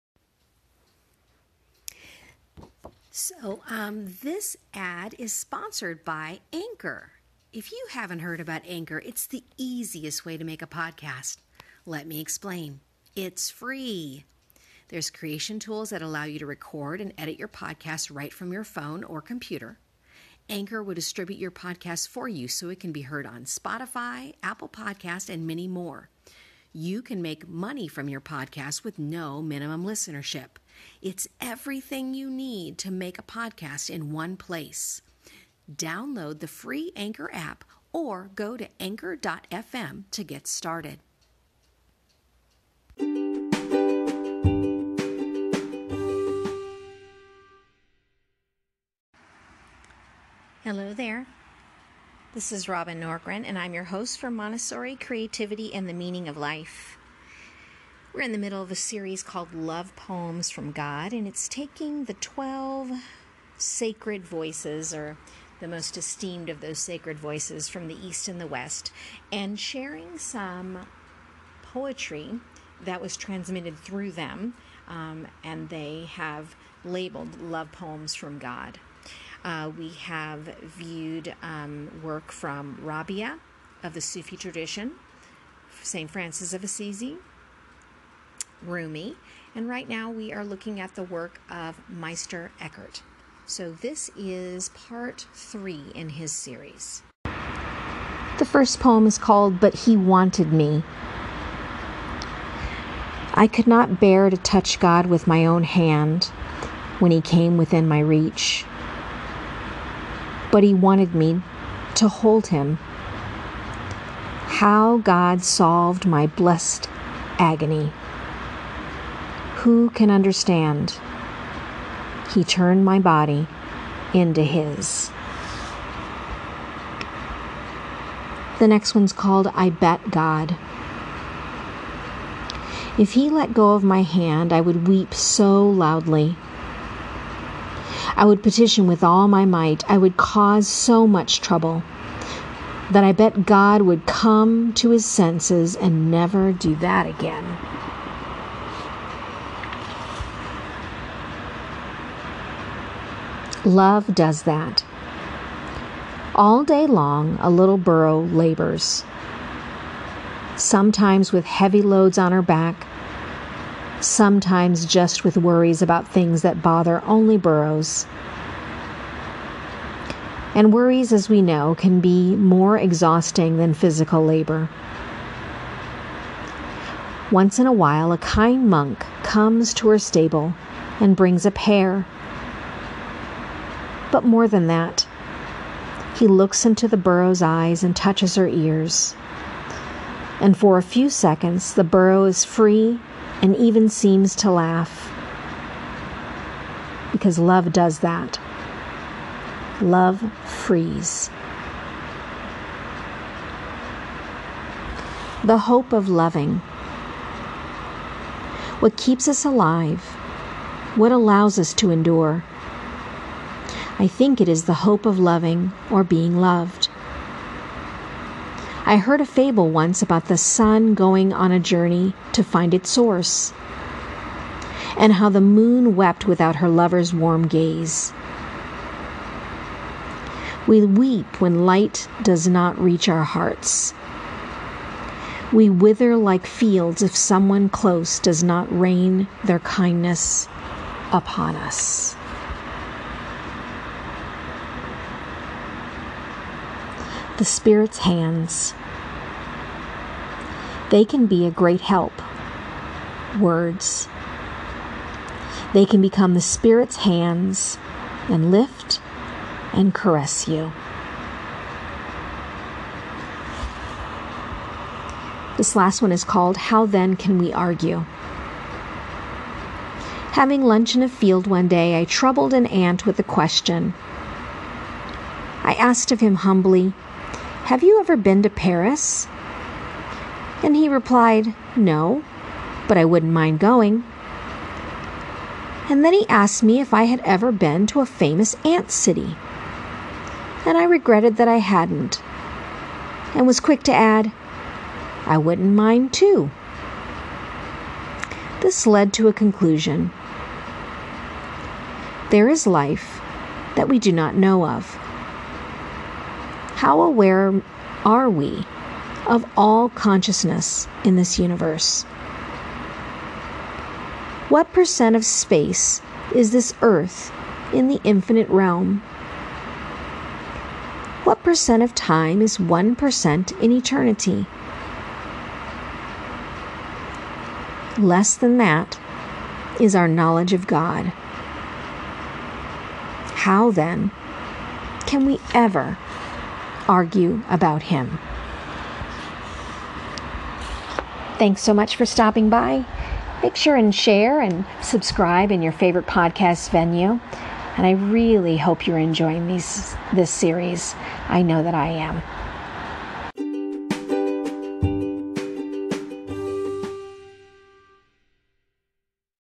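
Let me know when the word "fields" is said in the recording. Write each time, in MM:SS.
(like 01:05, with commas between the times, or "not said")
03:56, 04:31.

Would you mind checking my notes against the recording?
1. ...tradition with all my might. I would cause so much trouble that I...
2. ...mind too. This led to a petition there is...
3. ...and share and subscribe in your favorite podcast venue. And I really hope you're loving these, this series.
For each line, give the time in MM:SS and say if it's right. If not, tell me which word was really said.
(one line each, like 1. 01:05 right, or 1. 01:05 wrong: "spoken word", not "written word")
1. 02:18 wrong: "petition", not "tradition"
2. 04:55 wrong: "conclusion", not "petition"
3. 05:43 wrong: "enjoying", not "loving".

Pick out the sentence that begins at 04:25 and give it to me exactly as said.
This last one is called How Then Can We Argue?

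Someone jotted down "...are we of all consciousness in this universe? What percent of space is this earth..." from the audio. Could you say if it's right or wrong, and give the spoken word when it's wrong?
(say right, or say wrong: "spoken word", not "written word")
right.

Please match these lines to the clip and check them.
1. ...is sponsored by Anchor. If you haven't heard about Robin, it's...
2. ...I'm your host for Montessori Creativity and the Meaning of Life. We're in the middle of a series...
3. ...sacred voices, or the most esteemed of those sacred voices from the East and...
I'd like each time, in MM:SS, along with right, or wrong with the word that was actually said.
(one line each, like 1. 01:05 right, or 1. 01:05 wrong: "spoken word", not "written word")
1. 00:05 wrong: "Anchor", not "Robin"
2. 00:53 right
3. 01:03 right.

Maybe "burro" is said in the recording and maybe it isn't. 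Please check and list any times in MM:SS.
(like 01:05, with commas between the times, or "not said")
02:37, 02:47, 03:06, 03:11.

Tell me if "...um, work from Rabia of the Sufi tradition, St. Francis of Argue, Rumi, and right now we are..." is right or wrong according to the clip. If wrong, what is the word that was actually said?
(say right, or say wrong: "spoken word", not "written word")
wrong: "Assisi", not "Argue".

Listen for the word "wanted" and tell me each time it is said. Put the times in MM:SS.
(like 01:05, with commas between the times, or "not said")
01:39, 01:50.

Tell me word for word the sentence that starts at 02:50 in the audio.
And worries, as we know, can be more exhausting than physical labor.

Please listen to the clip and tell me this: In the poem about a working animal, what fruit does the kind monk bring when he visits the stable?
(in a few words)
A pear.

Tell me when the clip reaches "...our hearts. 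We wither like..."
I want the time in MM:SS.
03:53.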